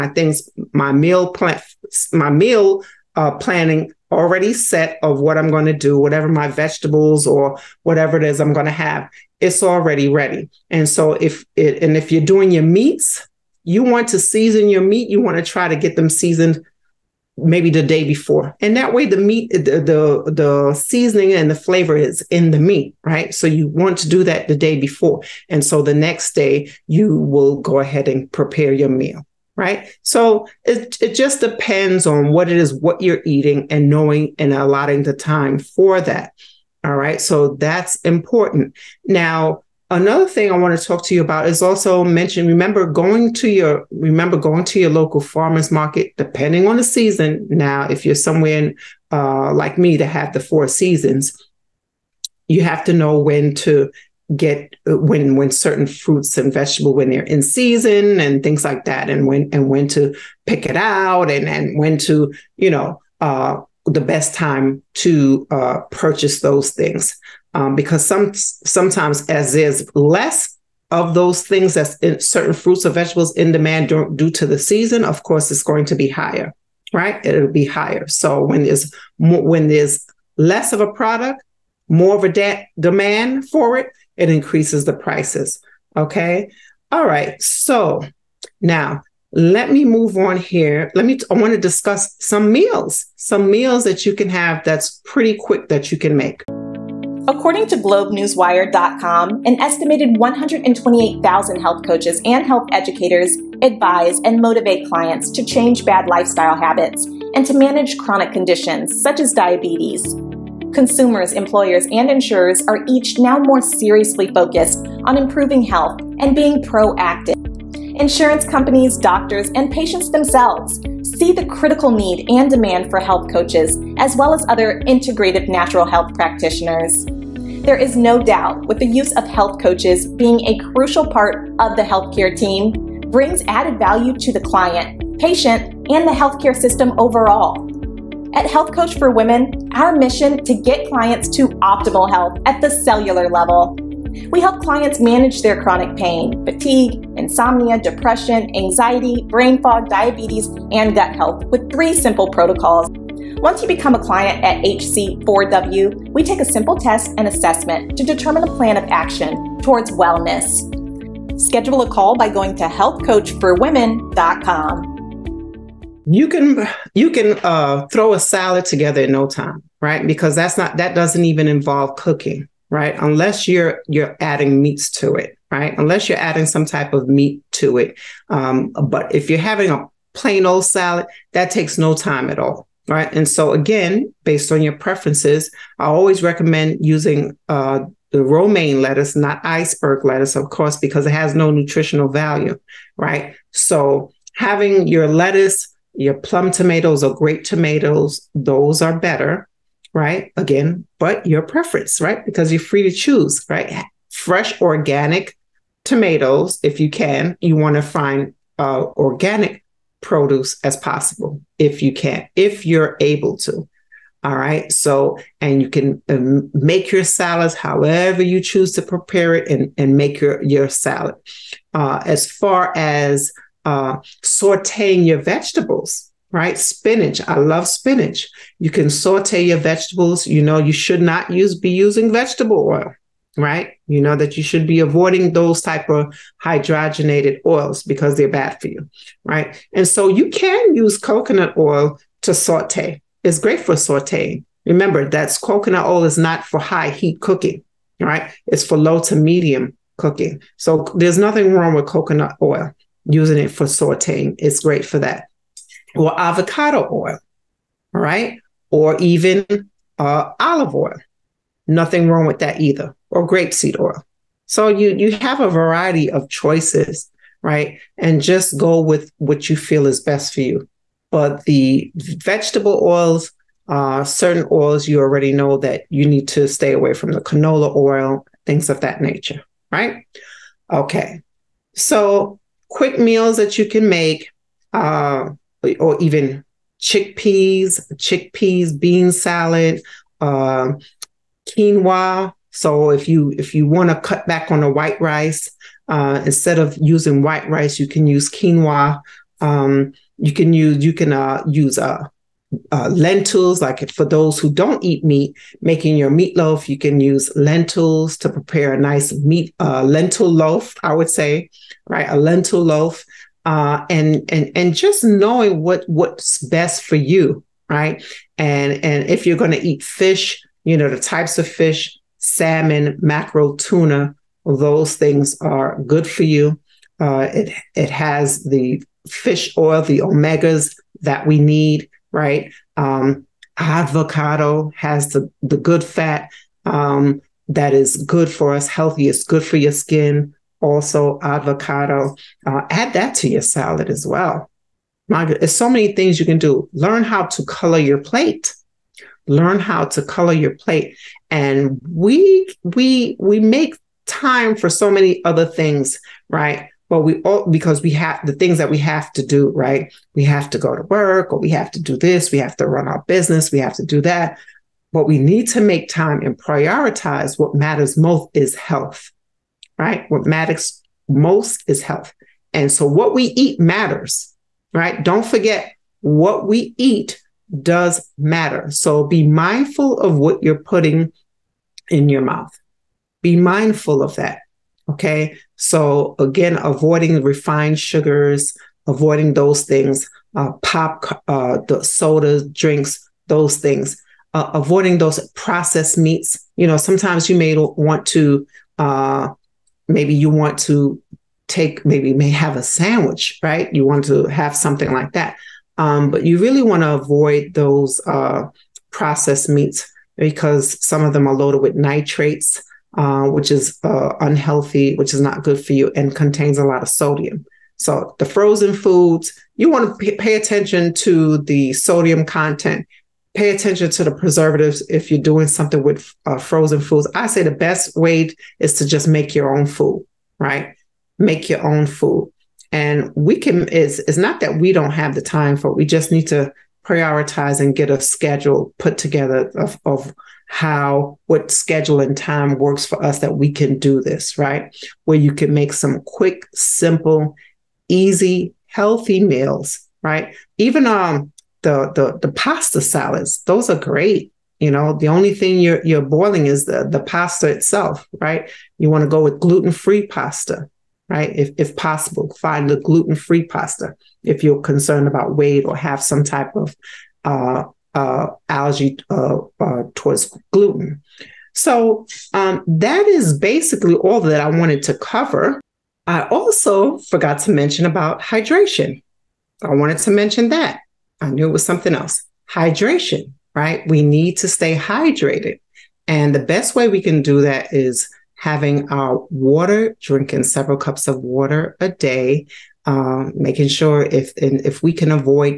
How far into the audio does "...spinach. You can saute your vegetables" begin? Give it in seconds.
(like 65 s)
227 s.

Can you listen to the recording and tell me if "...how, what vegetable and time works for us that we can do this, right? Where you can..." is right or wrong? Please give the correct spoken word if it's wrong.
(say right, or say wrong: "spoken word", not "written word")
wrong: "schedule", not "vegetable".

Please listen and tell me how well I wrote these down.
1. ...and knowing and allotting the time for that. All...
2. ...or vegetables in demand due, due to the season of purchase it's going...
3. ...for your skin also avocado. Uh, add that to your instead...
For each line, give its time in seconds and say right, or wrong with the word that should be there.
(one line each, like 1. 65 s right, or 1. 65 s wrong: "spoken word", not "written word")
1. 33 s right
2. 72 s wrong: "course", not "purchase"
3. 339 s wrong: "salad", not "instead".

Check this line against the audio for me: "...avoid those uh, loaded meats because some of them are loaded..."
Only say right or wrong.
wrong.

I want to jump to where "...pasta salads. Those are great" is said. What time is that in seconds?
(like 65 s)
452 s.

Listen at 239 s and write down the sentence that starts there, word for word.
And so you can use coconut oil to saute.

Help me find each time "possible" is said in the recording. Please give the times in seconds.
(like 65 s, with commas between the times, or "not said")
210 s, 461 s.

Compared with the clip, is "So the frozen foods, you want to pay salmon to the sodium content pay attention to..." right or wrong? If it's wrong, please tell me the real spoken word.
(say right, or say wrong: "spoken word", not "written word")
wrong: "attention", not "salmon".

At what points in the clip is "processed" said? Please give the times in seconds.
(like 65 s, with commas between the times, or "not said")
395 s, 408 s.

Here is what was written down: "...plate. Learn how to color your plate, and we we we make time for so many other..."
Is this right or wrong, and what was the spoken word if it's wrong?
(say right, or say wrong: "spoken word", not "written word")
right.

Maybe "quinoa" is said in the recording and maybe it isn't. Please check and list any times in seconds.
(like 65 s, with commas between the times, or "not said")
291 s, 298 s.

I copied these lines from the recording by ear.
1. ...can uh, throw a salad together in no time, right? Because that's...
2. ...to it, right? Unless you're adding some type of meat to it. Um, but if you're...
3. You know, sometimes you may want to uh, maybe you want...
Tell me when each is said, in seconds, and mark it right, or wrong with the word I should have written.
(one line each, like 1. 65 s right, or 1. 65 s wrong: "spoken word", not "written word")
1. 167 s right
2. 174 s right
3. 396 s right.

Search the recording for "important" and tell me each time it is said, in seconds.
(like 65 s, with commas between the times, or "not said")
37 s.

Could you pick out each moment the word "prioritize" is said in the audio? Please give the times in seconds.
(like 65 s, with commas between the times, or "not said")
366 s, 436 s.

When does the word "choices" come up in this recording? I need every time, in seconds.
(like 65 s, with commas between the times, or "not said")
266 s.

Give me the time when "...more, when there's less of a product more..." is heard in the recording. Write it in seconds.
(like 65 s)
79 s.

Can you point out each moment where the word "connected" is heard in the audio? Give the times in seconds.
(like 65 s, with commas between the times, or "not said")
not said.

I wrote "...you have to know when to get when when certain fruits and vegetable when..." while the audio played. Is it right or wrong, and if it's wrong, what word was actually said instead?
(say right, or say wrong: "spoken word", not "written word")
right.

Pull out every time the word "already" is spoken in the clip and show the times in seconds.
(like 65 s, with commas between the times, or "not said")
4 s, 9 s, 274 s.